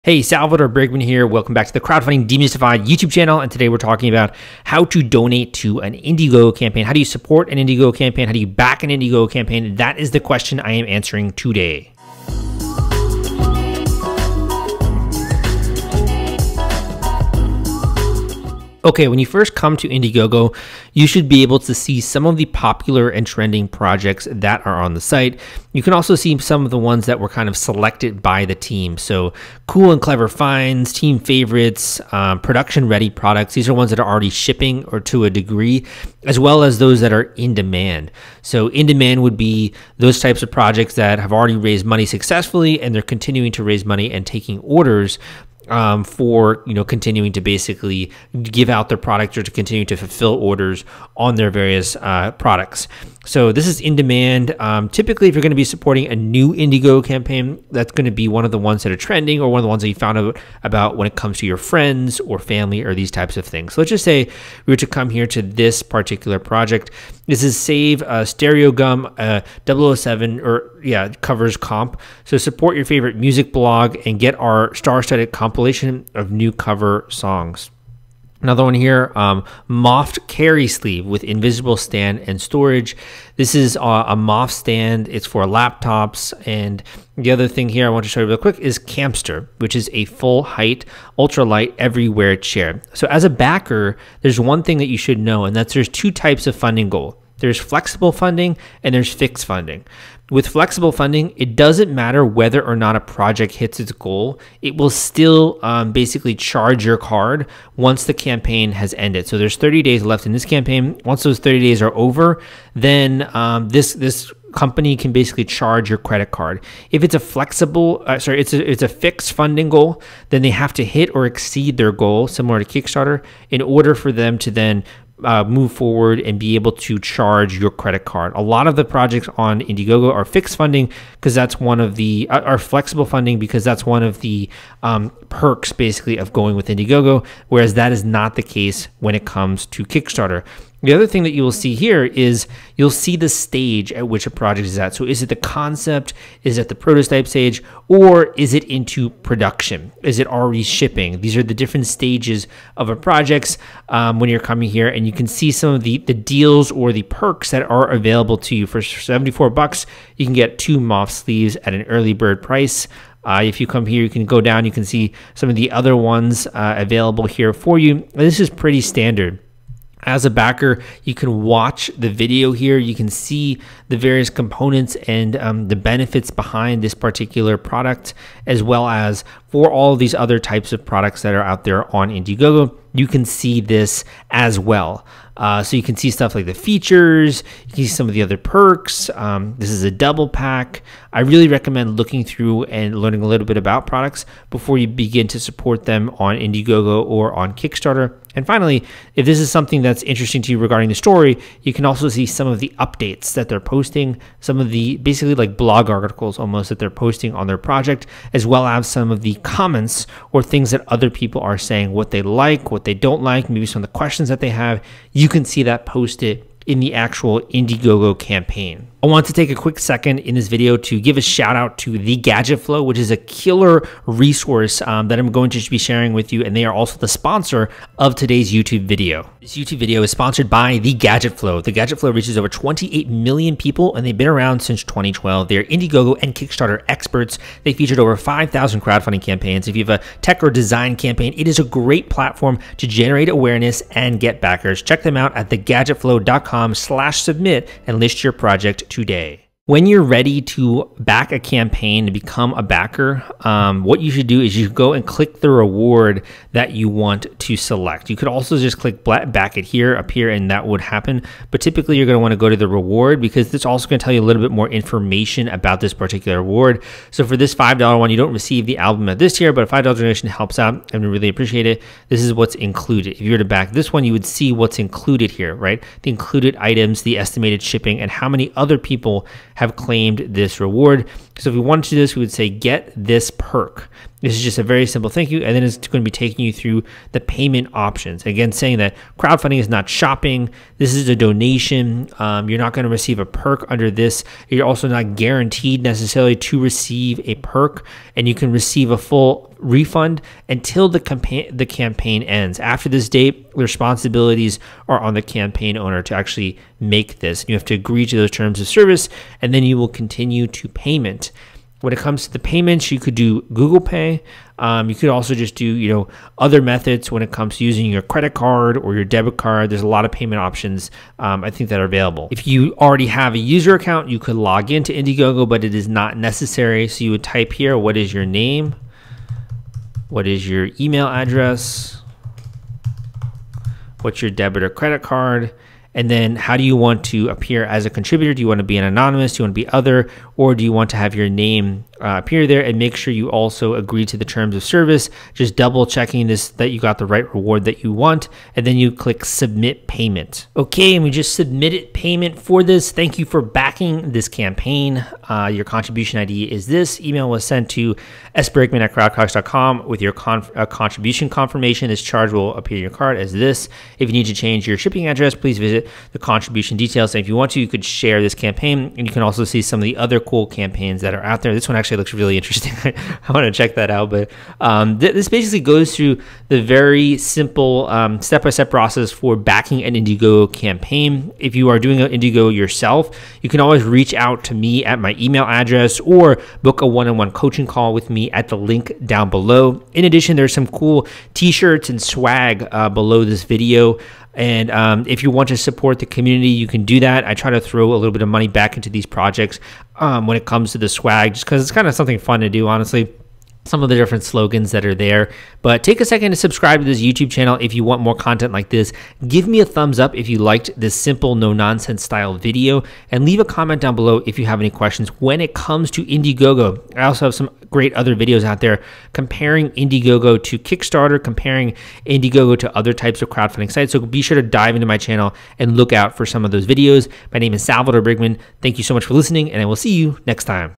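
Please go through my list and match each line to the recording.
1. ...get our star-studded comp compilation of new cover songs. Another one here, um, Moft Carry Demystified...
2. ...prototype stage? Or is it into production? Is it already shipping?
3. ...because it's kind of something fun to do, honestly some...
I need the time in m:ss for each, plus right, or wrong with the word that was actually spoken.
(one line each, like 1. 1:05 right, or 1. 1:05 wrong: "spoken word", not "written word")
1. 1:14 wrong: "Sleeve", not "Demystified"
2. 2:26 right
3. 6:41 right.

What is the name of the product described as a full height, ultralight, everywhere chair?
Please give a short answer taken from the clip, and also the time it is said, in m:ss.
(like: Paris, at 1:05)
Campster, at 1:28.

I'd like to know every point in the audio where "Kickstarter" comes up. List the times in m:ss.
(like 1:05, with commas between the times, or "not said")
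2:02, 2:19, 3:17, 3:56, 7:00.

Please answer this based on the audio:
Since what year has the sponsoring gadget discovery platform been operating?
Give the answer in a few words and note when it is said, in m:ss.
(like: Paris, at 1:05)
2012, at 3:54.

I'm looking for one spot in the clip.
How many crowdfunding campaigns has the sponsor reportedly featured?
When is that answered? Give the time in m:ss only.
3:58.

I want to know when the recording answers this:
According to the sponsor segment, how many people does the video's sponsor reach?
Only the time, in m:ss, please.
3:52.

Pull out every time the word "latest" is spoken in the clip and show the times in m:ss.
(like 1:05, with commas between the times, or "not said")
not said.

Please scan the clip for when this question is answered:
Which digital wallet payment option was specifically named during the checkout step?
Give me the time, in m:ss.
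5:13.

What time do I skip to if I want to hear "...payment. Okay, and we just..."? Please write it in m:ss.
5:49.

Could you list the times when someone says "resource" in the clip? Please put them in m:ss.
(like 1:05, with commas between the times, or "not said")
3:44.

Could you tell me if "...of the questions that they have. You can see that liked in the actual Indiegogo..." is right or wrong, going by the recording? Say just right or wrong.
wrong.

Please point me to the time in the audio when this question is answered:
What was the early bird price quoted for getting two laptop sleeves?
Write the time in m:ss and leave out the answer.
2:38.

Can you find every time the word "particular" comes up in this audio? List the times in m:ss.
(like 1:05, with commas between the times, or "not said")
1:05, 2:56, 4:25.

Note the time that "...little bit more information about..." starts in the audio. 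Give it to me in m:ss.
4:24.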